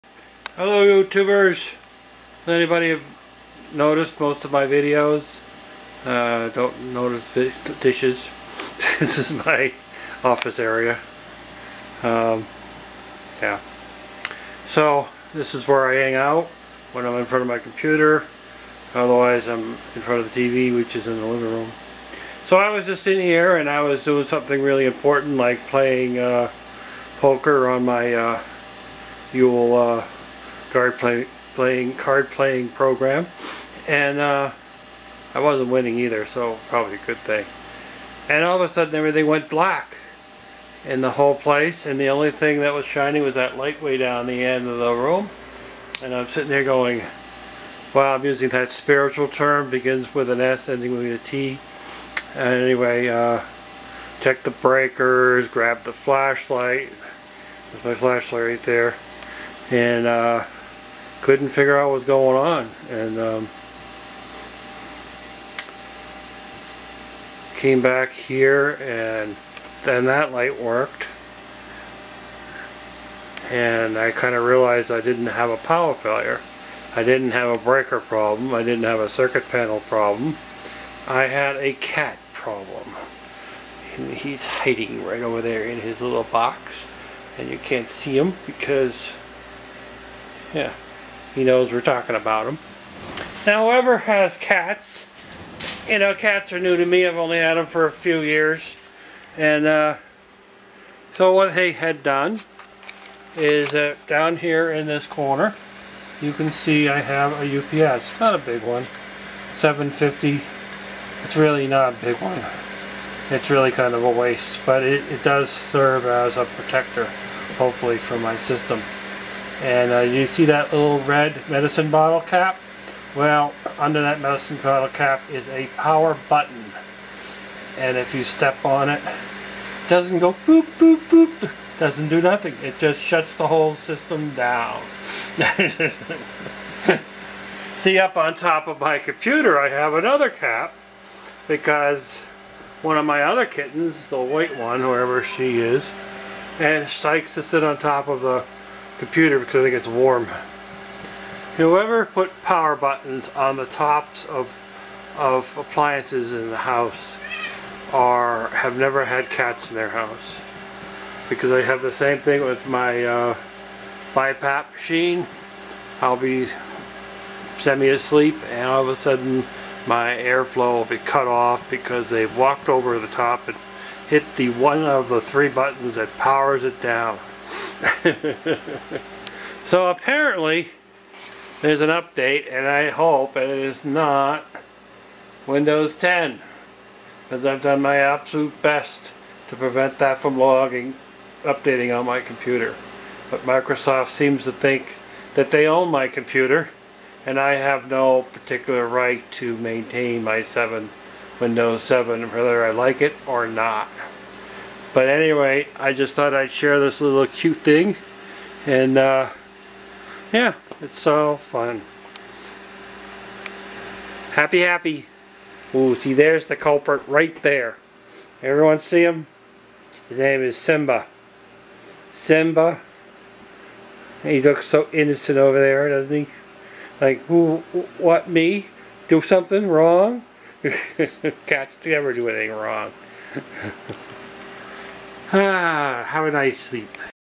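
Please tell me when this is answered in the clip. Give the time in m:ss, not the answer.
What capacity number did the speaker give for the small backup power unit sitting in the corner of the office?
1:49.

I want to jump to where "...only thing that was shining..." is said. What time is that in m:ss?
0:42.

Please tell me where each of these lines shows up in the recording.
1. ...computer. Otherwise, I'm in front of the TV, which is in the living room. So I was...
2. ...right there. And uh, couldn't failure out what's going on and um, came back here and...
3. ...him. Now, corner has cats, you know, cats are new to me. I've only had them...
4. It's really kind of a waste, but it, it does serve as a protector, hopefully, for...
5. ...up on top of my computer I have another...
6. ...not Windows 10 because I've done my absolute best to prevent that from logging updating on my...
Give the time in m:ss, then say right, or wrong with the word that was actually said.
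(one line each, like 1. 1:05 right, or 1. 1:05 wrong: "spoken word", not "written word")
1. 0:17 right
2. 0:58 wrong: "figure", not "failure"
3. 1:32 wrong: "whoever", not "corner"
4. 1:53 right
5. 2:17 right
6. 3:03 right.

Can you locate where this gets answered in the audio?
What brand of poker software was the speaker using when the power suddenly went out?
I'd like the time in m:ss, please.
0:29.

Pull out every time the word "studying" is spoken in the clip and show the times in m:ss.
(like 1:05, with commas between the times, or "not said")
not said.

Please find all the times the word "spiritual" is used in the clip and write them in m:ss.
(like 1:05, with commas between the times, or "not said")
0:48.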